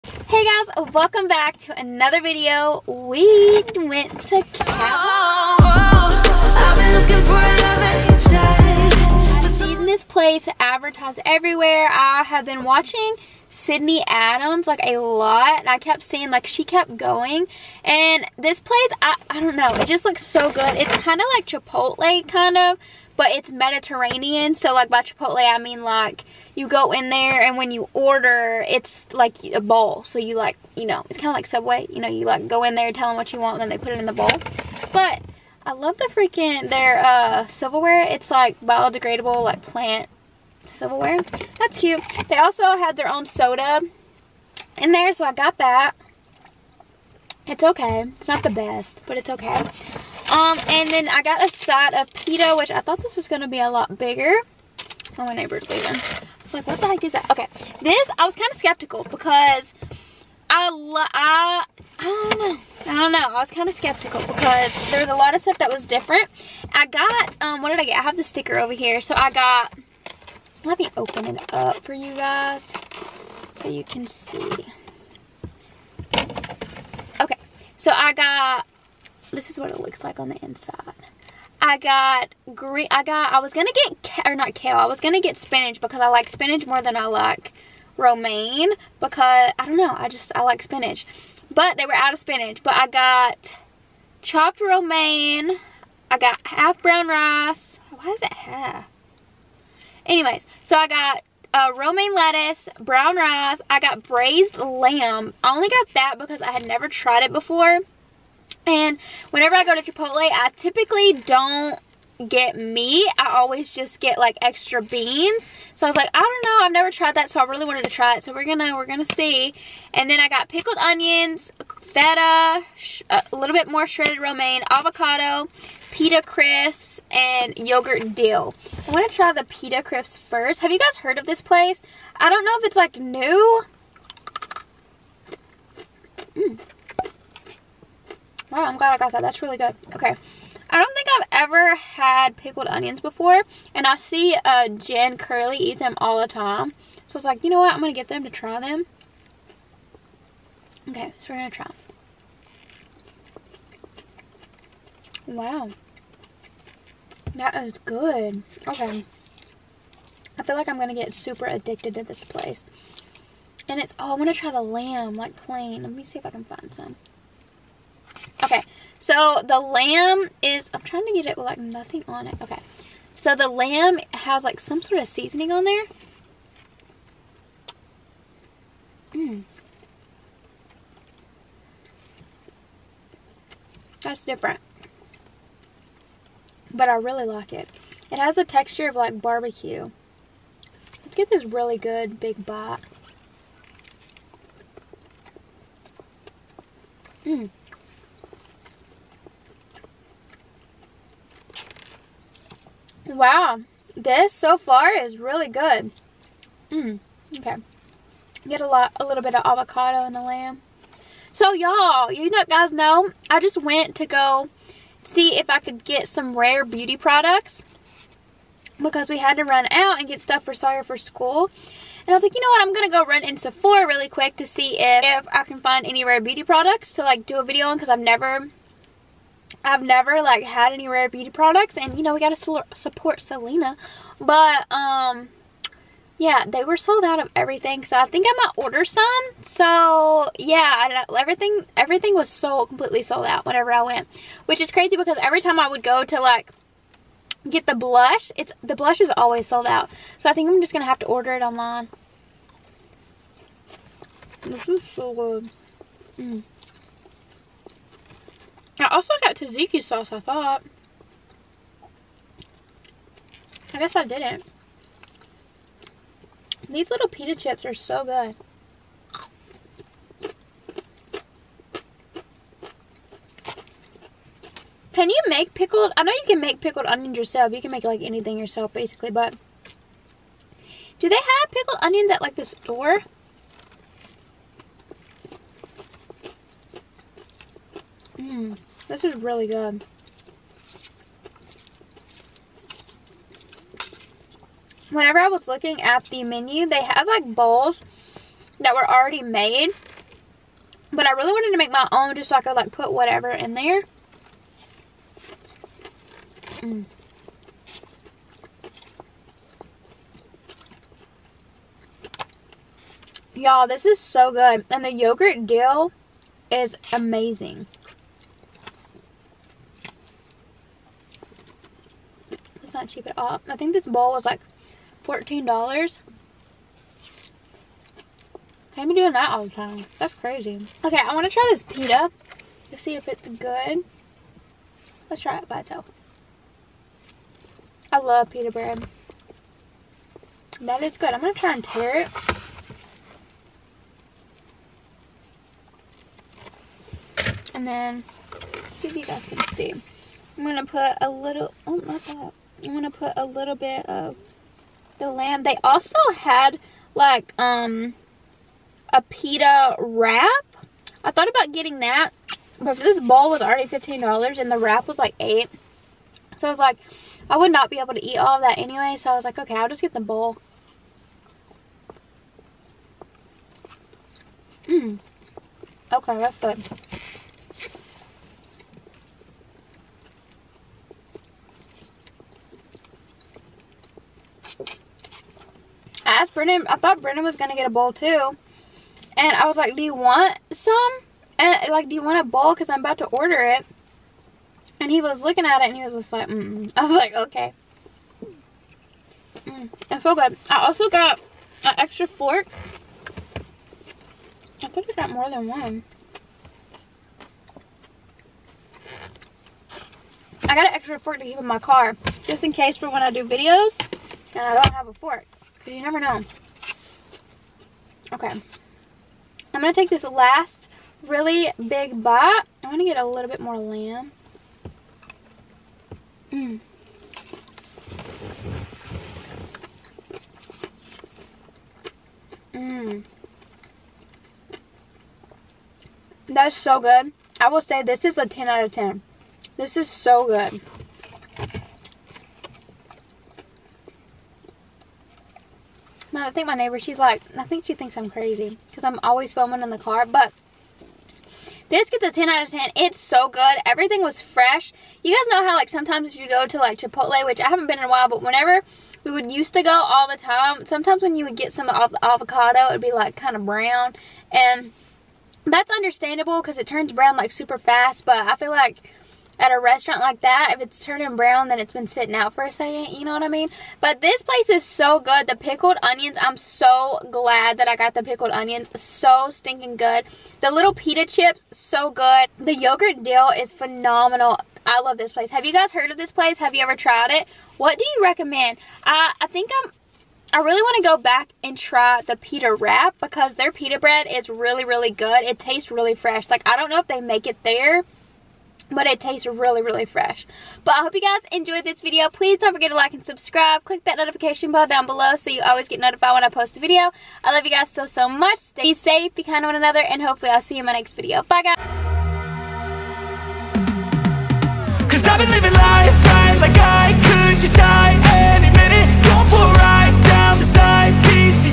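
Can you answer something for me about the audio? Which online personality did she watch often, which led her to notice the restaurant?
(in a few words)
Sydney Adams.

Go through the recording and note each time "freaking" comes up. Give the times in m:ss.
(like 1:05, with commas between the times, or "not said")
0:36.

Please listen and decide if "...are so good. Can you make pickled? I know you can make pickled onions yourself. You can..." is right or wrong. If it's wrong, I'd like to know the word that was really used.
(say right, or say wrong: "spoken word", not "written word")
right.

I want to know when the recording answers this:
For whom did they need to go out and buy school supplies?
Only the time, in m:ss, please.
3:40.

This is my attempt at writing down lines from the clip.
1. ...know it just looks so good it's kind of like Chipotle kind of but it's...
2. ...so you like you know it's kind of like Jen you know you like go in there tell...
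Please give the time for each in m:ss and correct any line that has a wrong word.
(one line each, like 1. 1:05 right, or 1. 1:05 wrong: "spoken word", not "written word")
1. 0:19 right
2. 0:30 wrong: "Subway", not "Jen".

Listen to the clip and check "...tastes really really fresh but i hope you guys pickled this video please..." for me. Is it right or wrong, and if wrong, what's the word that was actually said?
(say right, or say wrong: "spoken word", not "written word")
wrong: "enjoyed", not "pickled".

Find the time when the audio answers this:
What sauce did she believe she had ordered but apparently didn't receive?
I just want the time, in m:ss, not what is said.
4:19.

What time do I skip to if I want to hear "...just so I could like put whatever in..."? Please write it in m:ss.
5:02.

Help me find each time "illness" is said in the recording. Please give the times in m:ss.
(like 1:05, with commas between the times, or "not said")
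not said.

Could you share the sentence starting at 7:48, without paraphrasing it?
But I feel like at a restaurant like that, if it's turning brown, then it's been sitting out for a second.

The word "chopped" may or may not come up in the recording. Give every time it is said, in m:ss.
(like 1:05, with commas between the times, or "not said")
1:34.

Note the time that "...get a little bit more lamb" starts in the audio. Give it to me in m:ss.
7:02.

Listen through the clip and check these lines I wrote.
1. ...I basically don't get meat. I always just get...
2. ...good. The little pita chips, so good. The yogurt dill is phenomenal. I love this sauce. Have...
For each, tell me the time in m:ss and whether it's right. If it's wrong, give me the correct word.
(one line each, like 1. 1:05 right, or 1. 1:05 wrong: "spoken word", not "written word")
1. 1:50 wrong: "typically", not "basically"
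2. 7:59 wrong: "place", not "sauce".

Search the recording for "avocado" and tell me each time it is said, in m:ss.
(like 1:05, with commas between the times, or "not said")
2:04, 3:29, 7:42.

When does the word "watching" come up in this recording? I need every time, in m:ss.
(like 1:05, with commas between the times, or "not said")
0:12.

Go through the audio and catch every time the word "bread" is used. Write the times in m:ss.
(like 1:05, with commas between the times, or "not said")
5:38, 8:13.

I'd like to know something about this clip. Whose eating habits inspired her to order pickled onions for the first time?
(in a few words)
Jen Curly.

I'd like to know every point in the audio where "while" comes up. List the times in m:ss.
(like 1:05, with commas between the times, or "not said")
7:37.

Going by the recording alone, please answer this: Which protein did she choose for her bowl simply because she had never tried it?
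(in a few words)
Braised lamb.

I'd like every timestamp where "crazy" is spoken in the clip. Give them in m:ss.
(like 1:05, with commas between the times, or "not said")
4:04, 5:30, 7:28.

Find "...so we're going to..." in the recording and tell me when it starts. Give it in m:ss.
2:31.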